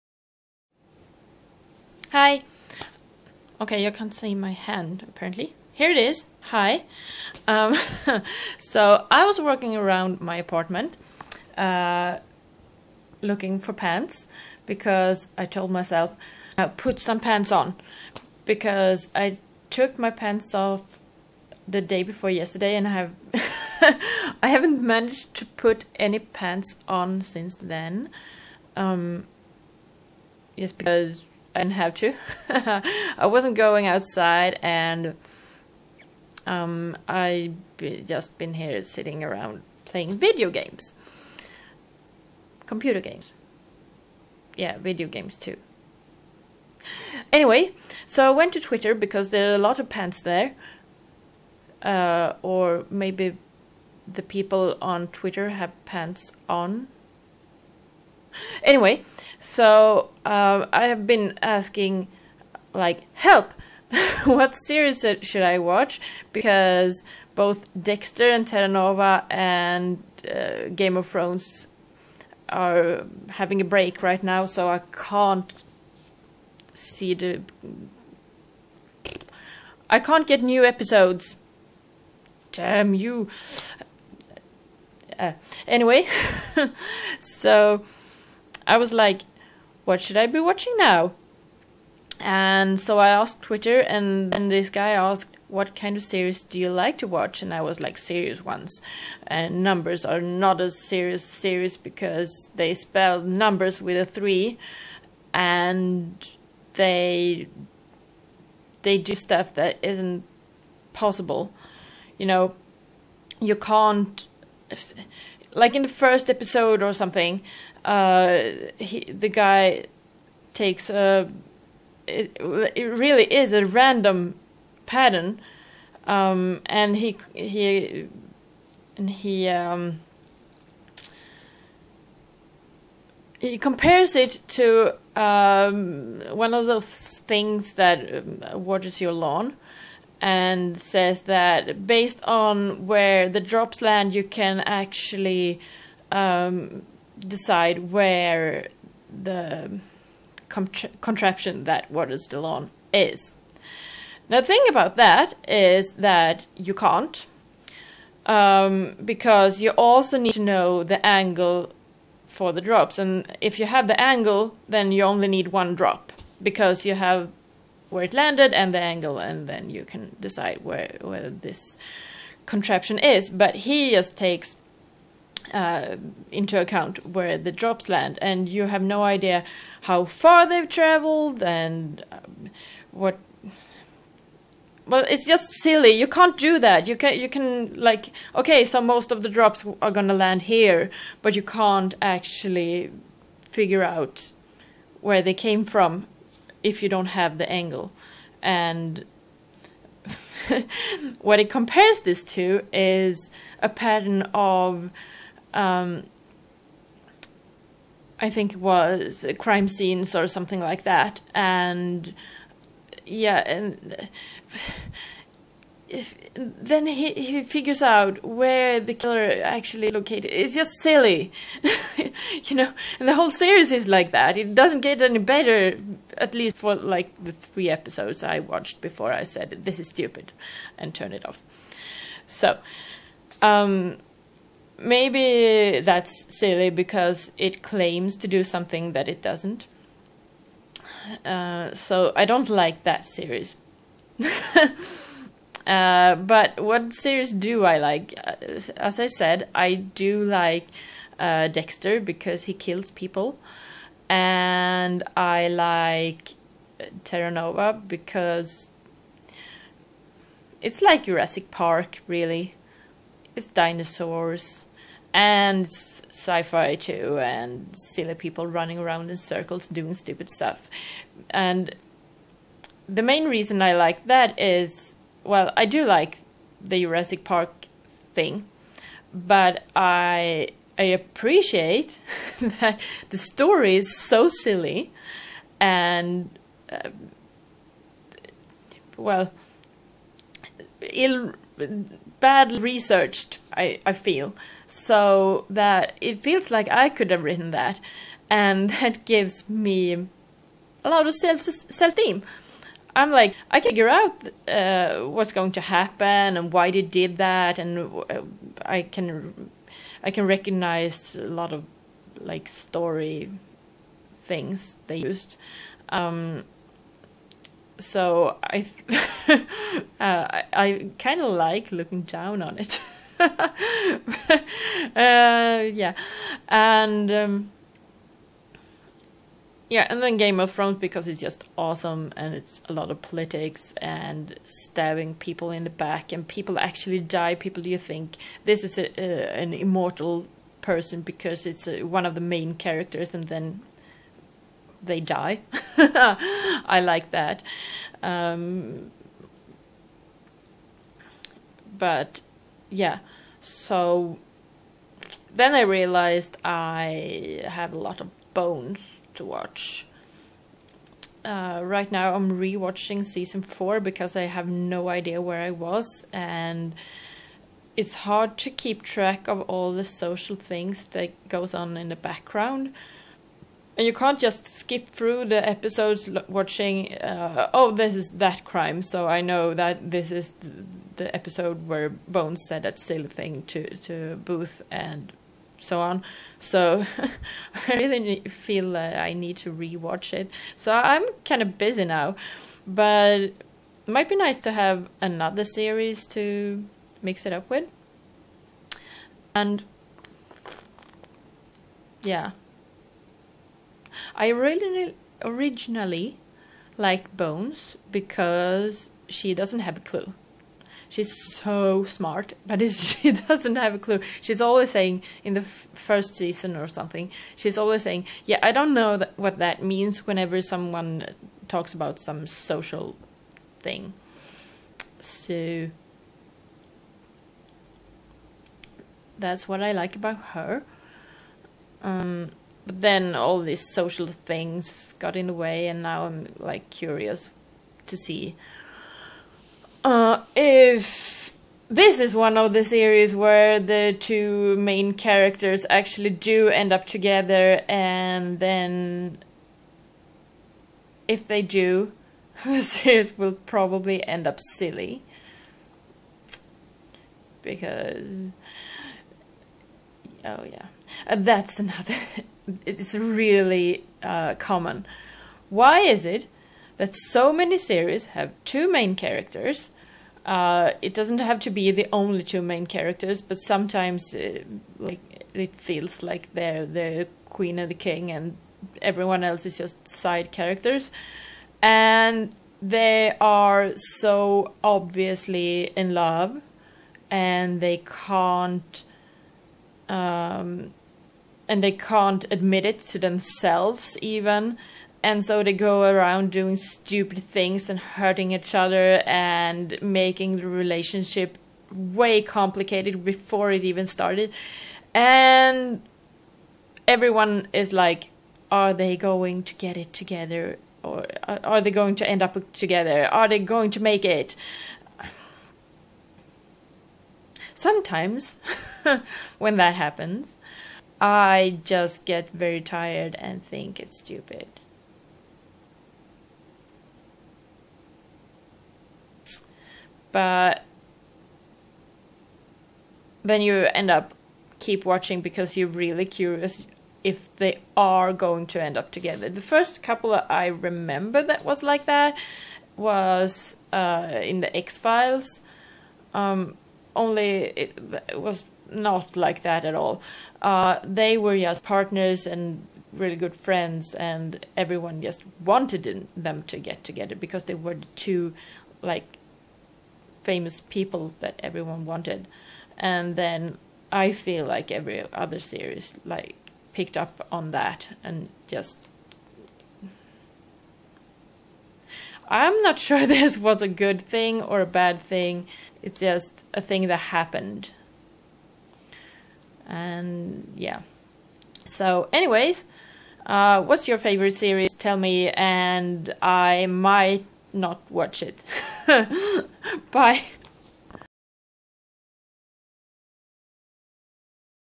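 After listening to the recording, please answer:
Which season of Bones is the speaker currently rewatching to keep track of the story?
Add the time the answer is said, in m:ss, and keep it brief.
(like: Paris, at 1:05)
Season 4, at 6:03.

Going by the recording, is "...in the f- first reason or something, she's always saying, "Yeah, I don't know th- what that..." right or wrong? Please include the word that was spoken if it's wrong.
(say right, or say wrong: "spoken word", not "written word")
wrong: "season", not "reason".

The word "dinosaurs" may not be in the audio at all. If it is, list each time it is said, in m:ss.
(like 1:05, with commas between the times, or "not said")
4:23.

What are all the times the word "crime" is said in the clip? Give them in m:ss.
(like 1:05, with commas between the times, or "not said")
3:29, 6:18.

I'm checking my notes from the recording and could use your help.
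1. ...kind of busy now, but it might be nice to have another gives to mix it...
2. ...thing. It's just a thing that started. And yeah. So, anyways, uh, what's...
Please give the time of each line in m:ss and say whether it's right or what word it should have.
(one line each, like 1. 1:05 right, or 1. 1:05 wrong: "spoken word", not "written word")
1. 6:31 wrong: "series", not "gives"
2. 9:34 wrong: "happened", not "started".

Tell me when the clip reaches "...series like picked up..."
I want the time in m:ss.
9:25.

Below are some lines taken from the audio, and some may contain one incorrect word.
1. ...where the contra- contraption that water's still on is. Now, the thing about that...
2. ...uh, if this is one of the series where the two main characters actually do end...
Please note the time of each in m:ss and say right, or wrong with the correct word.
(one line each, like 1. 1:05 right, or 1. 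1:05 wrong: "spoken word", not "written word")
1. 2:27 right
2. 7:19 right.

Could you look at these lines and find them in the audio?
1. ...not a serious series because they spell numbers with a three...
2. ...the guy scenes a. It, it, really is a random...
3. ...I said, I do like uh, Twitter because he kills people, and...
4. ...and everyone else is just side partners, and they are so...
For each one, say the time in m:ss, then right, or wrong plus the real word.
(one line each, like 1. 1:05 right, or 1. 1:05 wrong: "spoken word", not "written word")
1. 1:40 right
2. 1:59 wrong: "takes", not "scenes"
3. 4:08 wrong: "Dexter", not "Twitter"
4. 7:58 wrong: "characters", not "partners".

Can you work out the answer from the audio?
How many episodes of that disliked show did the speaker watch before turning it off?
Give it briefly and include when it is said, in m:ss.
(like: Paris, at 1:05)
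3, at 3:47.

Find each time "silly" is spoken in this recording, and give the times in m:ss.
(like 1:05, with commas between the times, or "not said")
3:05, 3:40, 3:56, 4:27, 4:44, 6:22, 7:34.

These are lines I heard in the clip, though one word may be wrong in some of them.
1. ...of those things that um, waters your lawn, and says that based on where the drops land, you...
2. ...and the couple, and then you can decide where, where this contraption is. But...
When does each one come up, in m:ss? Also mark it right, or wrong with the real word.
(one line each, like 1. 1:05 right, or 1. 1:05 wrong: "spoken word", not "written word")
1. 2:16 right
2. 2:48 wrong: "angle", not "couple".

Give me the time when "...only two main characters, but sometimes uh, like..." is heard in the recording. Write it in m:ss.
7:51.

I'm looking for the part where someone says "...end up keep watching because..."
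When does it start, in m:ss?
8:53.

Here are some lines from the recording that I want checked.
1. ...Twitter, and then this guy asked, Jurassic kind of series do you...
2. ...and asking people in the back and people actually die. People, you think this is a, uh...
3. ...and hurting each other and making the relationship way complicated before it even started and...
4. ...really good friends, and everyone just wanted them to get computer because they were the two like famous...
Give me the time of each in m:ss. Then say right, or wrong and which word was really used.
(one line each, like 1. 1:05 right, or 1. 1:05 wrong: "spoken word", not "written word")
1. 1:33 wrong: "What", not "Jurassic"
2. 5:33 wrong: "stabbing", not "asking"
3. 8:17 right
4. 9:12 wrong: "together", not "computer".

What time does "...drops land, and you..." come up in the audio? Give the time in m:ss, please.
2:57.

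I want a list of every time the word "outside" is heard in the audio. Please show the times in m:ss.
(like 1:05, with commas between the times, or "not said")
0:33.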